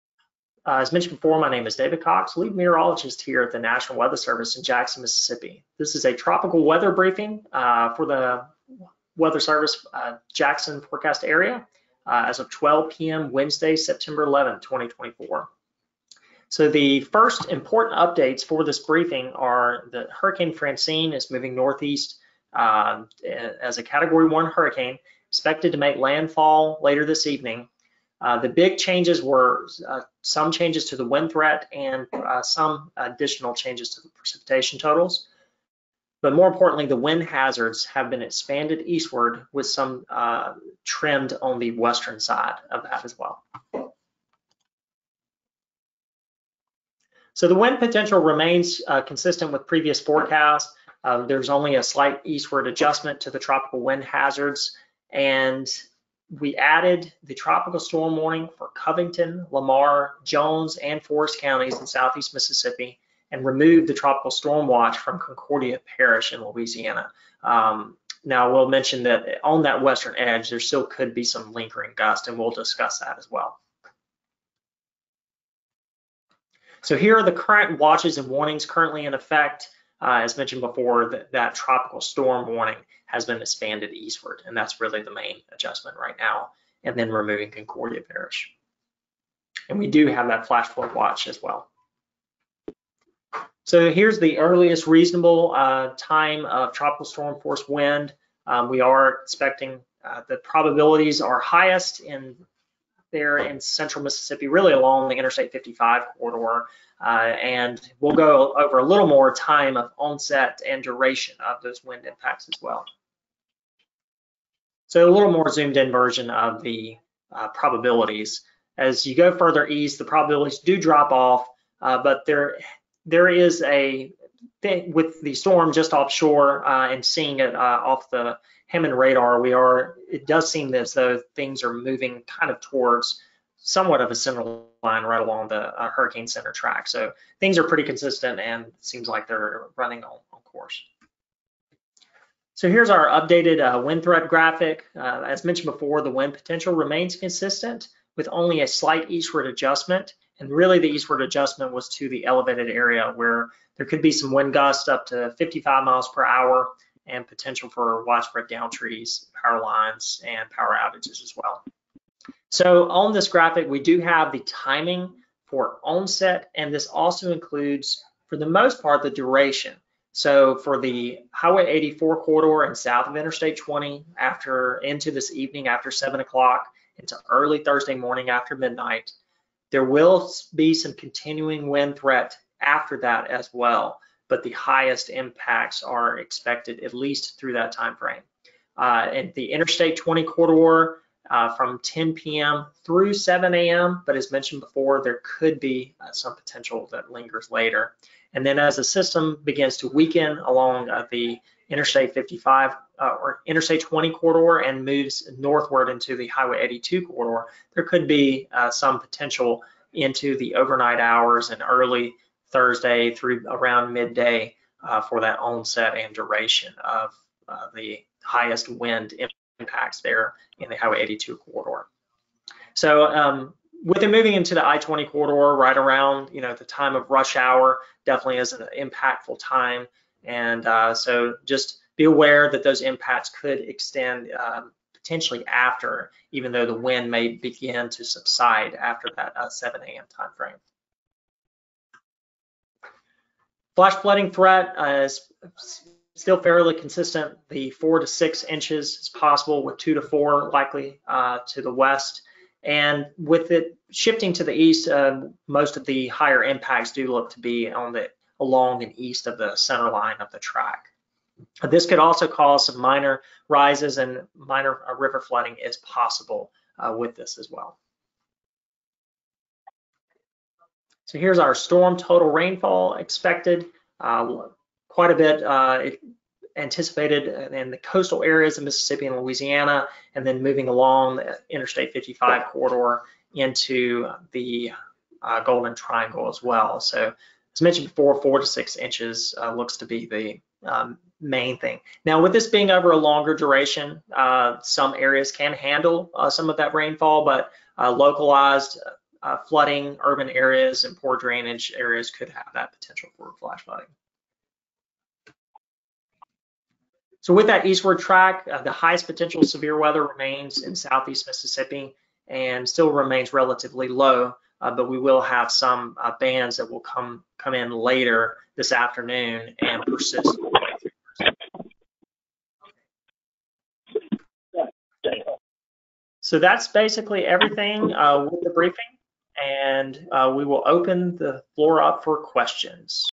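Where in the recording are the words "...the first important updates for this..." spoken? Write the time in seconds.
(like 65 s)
16 s.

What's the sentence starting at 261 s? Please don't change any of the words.
This could also cause some minor rises and minor uh, river flooding is possible uh, with this as well.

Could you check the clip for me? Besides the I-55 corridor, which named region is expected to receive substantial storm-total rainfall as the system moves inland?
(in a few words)
Golden Triangle.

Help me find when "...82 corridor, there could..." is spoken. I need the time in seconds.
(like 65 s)
206 s.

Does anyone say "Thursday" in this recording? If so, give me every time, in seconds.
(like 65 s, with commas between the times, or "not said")
177 s, 212 s.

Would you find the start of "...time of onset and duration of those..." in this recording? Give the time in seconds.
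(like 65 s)
109 s.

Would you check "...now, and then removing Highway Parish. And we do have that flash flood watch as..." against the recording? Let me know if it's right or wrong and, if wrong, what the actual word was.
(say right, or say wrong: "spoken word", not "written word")
wrong: "Concordia", not "Highway".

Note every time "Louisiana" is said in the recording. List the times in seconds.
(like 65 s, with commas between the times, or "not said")
66 s, 279 s.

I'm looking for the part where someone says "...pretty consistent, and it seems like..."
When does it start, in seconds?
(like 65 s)
137 s.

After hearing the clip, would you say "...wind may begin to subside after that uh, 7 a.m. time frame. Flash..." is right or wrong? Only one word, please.
right.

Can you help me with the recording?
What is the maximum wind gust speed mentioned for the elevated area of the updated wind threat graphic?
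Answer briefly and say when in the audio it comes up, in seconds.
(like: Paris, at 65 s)
55 miles per hour, at 155 s.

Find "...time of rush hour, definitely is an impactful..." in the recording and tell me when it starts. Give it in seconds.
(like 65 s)
226 s.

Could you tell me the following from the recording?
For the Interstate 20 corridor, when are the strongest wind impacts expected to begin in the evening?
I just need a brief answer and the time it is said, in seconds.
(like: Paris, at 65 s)
10 p.m., at 191 s.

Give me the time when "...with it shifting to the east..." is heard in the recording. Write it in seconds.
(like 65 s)
253 s.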